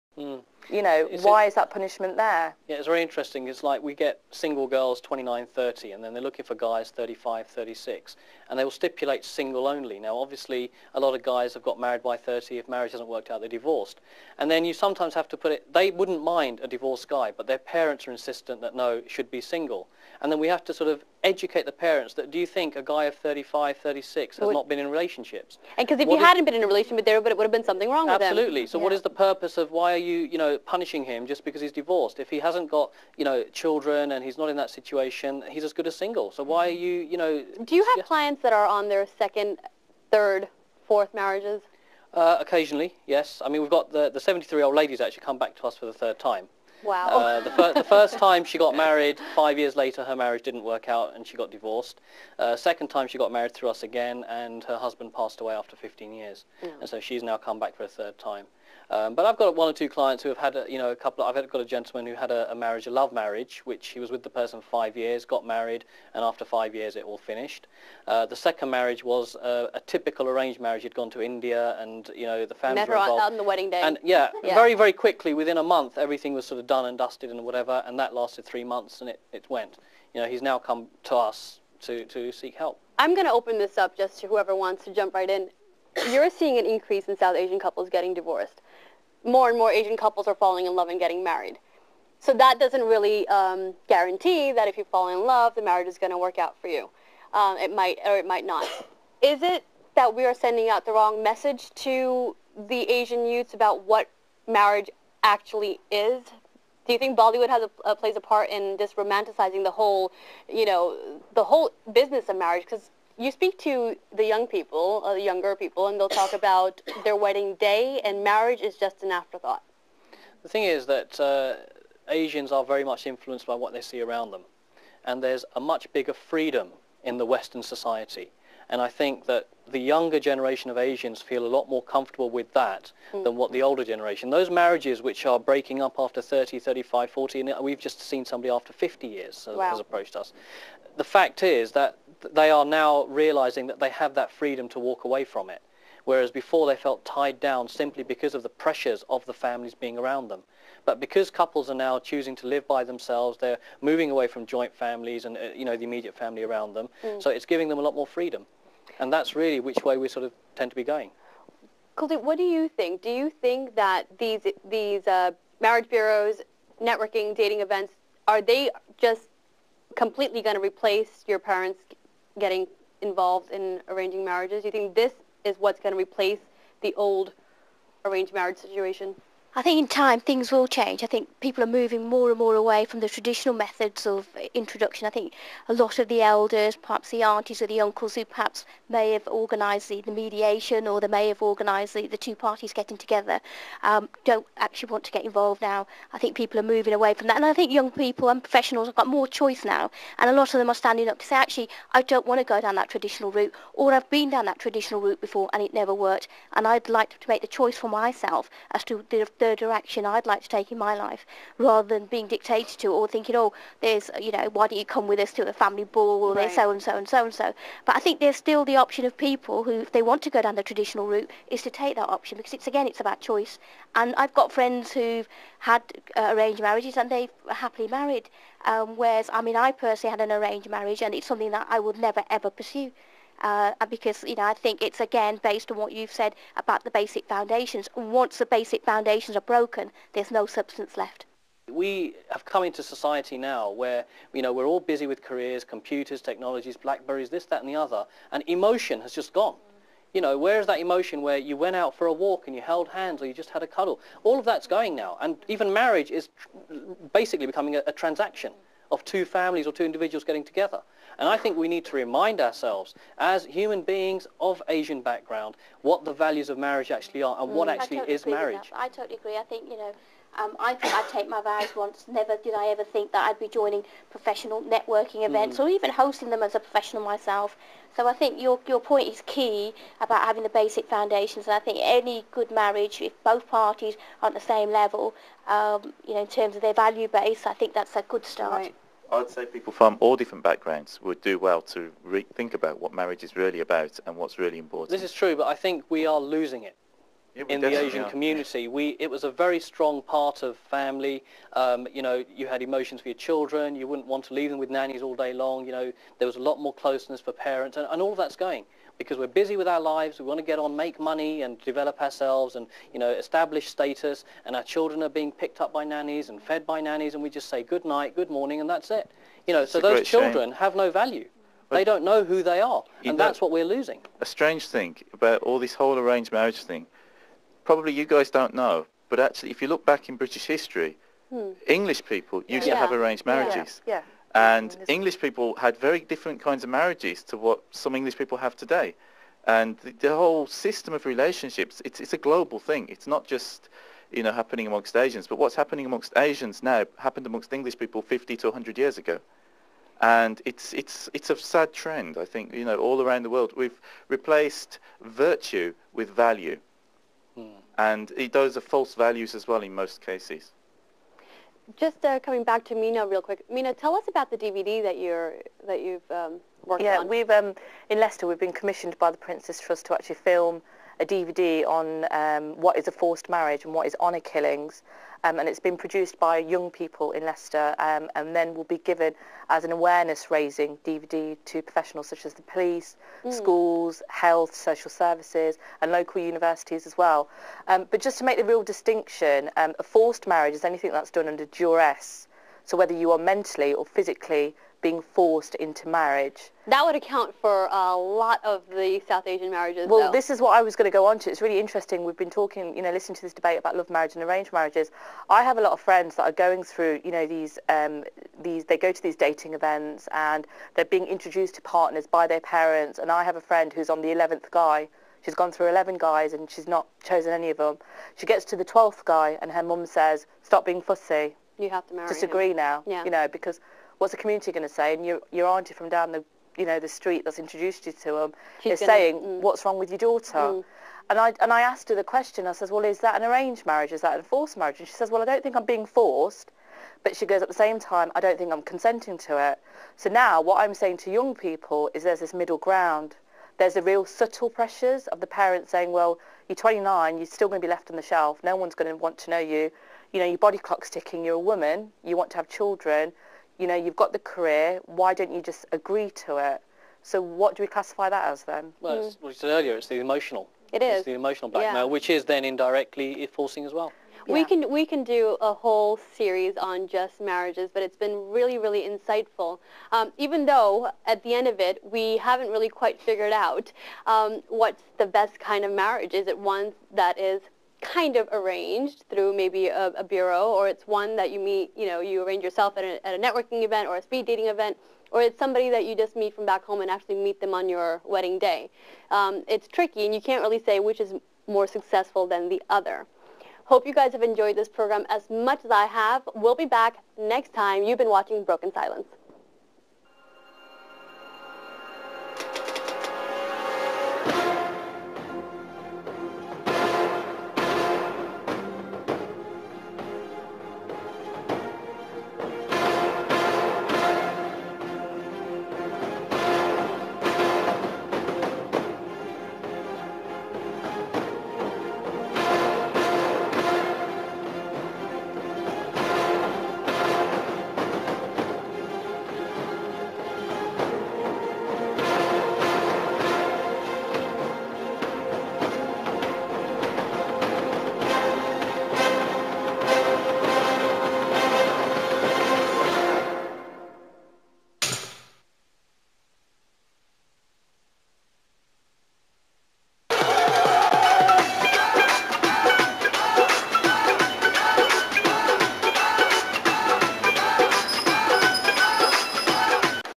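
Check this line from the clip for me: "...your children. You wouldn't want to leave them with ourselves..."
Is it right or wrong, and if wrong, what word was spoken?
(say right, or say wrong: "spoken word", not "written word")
wrong: "nannies", not "ourselves".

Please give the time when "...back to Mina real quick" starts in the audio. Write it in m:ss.
6:02.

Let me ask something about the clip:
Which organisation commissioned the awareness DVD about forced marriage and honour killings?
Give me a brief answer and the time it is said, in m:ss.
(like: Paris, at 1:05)
the Prince's Trust, at 6:09.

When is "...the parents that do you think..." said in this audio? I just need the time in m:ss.
0:21.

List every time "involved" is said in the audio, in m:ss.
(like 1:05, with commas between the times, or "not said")
1:12, 2:53, 3:15.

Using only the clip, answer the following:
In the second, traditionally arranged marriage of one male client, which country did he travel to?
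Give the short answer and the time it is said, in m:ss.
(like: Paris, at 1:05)
India, at 1:11.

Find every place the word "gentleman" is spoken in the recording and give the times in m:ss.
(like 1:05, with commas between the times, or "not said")
1:01.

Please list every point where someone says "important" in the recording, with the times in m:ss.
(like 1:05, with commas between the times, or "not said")
4:54.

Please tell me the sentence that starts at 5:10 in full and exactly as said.
We want to get on, make money, and develop ourselves, and you know, establish status.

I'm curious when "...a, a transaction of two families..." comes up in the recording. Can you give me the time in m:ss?
4:17.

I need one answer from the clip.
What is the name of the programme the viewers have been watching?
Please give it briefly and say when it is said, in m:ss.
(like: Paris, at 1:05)
Broken Silence, at 8:18.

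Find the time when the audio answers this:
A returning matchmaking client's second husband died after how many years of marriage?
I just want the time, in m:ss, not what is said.
0:55.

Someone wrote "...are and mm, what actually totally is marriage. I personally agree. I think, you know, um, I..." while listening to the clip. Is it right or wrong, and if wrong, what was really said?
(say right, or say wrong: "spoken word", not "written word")
wrong: "totally", not "personally".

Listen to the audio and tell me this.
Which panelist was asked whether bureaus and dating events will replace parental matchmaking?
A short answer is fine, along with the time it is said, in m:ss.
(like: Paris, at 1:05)
Kuldeep, at 2:41.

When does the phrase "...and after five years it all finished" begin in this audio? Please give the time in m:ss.
1:06.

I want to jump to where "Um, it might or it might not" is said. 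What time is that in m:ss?
1:37.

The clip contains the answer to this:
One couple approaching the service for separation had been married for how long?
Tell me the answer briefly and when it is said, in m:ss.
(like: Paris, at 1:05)
50 years, at 2:18.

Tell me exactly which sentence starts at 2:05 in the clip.
And there's a much bigger freedom in the Western society.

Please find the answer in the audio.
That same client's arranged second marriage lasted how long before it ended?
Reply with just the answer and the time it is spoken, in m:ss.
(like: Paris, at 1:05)
3 months, at 1:18.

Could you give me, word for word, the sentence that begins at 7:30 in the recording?
You know, your body clock's ticking.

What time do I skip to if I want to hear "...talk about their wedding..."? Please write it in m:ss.
1:56.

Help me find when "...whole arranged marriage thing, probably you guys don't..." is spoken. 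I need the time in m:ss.
5:25.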